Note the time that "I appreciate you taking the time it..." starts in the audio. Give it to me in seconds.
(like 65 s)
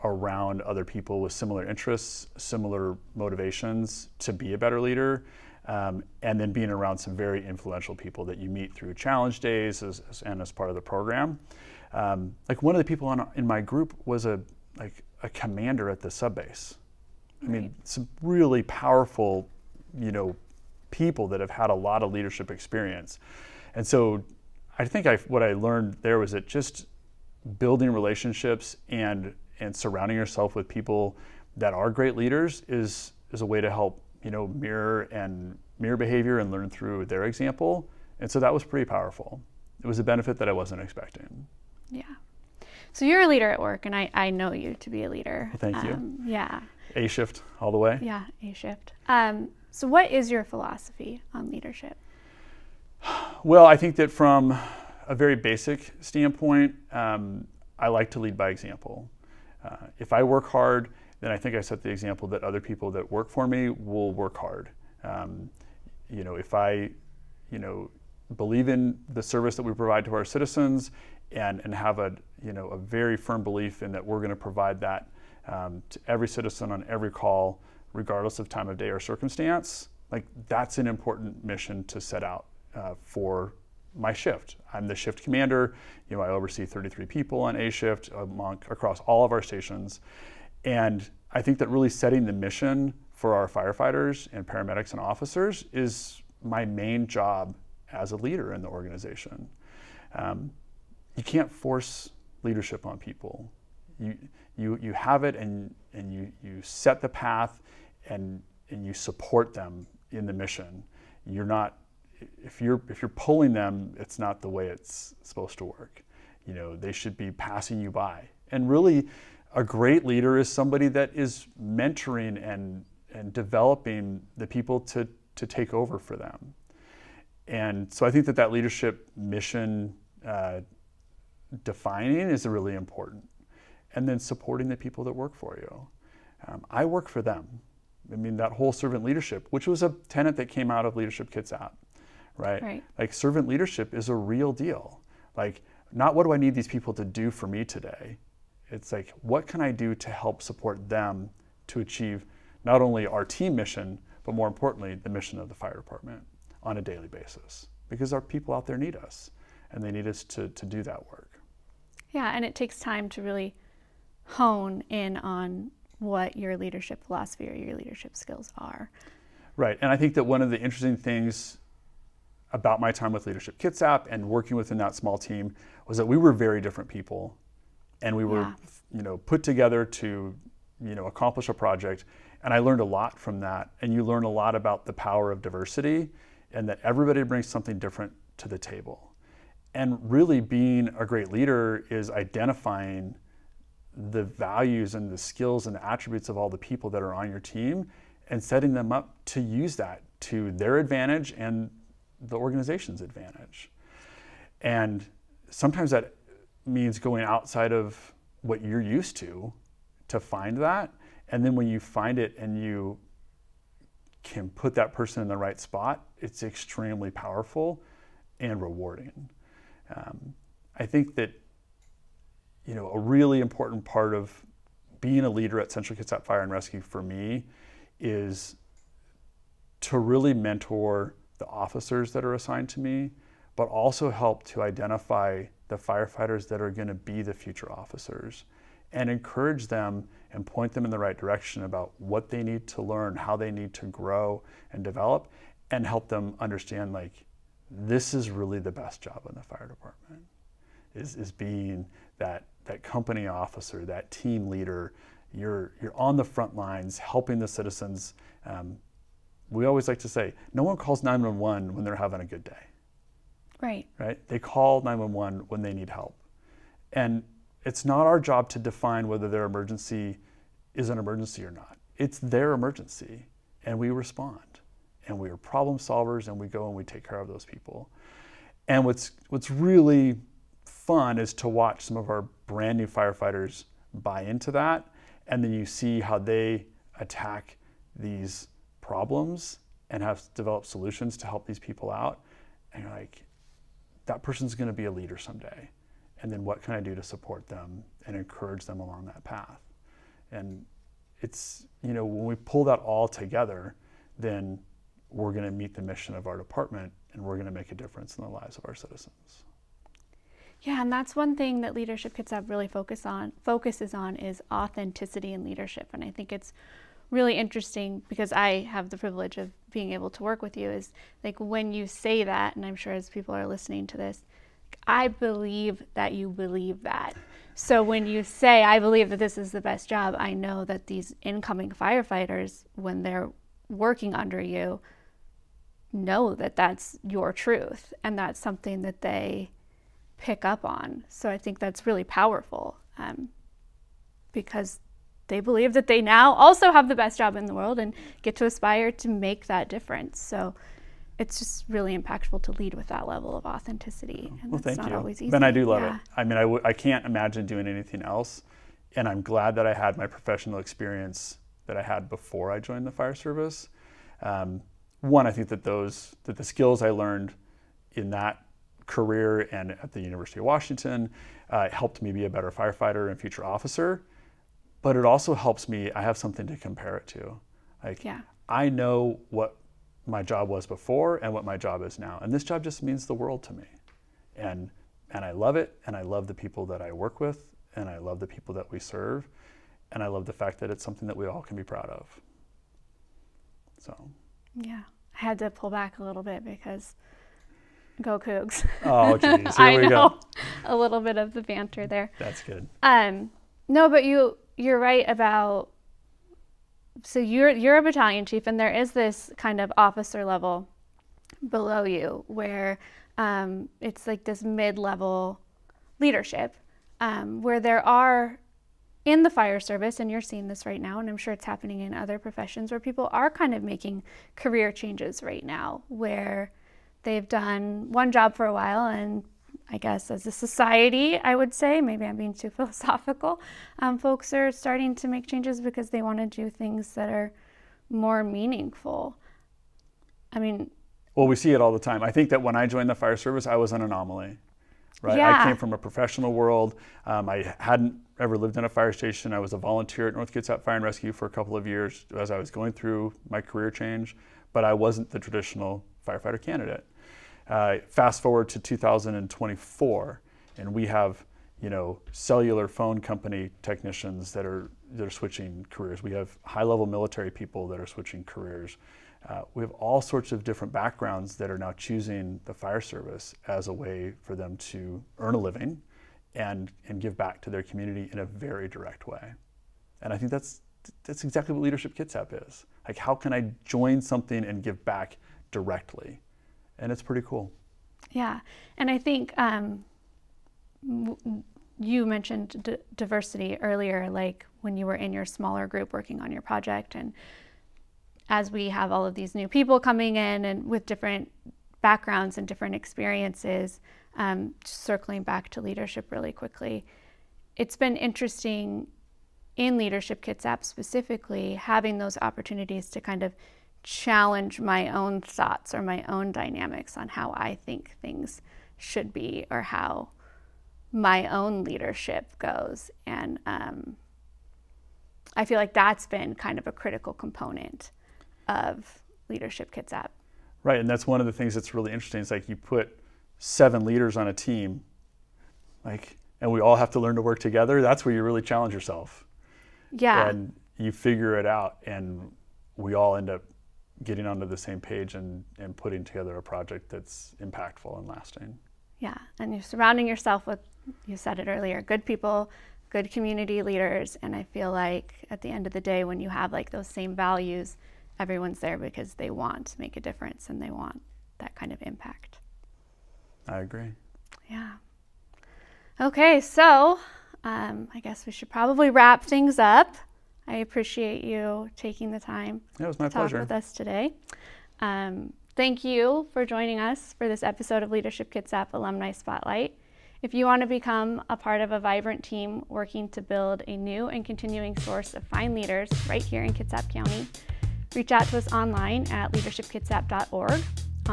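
570 s.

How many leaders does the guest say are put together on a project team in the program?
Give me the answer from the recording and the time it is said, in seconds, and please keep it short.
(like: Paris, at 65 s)
7, at 533 s.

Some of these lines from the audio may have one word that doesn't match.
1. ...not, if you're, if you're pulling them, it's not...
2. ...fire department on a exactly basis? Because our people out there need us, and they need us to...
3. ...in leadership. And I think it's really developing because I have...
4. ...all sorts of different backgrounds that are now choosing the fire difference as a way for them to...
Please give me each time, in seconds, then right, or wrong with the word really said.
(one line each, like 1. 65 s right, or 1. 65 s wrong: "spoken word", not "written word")
1. 111 s right
2. 155 s wrong: "daily", not "exactly"
3. 315 s wrong: "interesting", not "developing"
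4. 469 s wrong: "service", not "difference".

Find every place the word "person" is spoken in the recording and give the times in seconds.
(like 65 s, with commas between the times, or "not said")
214 s, 294 s.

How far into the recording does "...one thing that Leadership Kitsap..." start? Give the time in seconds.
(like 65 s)
311 s.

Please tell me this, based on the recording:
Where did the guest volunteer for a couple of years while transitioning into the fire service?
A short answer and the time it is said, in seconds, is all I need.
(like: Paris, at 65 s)
North Kitsap Fire and Rescue, at 450 s.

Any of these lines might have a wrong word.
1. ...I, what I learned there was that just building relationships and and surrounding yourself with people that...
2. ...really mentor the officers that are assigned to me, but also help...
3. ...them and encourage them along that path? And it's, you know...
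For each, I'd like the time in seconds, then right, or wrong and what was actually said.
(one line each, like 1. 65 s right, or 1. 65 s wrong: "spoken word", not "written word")
1. 25 s right
2. 229 s right
3. 297 s right.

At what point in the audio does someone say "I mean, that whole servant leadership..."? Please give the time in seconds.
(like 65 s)
138 s.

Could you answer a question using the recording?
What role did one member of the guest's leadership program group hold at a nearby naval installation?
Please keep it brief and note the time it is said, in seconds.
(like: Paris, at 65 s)
Commander at the sub base, at 15 s.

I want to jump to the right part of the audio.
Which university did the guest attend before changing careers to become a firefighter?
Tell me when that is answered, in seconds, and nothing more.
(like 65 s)
370 s.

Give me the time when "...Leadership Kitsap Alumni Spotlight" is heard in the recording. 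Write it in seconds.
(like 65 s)
577 s.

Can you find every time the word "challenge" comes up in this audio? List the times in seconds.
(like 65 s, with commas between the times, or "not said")
8 s, 513 s, 538 s.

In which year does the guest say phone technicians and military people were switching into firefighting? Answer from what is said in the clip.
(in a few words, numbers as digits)
2024.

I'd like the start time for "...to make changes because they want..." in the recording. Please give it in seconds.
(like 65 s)
434 s.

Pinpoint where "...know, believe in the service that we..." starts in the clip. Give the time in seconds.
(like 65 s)
67 s.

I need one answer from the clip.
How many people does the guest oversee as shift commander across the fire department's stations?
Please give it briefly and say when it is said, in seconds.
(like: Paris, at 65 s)
33, at 86 s.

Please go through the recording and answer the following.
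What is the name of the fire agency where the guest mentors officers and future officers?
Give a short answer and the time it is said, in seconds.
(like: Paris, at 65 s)
Central Kitsap Fire and Rescue, at 225 s.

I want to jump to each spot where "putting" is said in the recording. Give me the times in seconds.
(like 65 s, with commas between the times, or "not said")
545 s.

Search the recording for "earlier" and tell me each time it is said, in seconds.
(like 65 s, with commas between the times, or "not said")
493 s, 551 s.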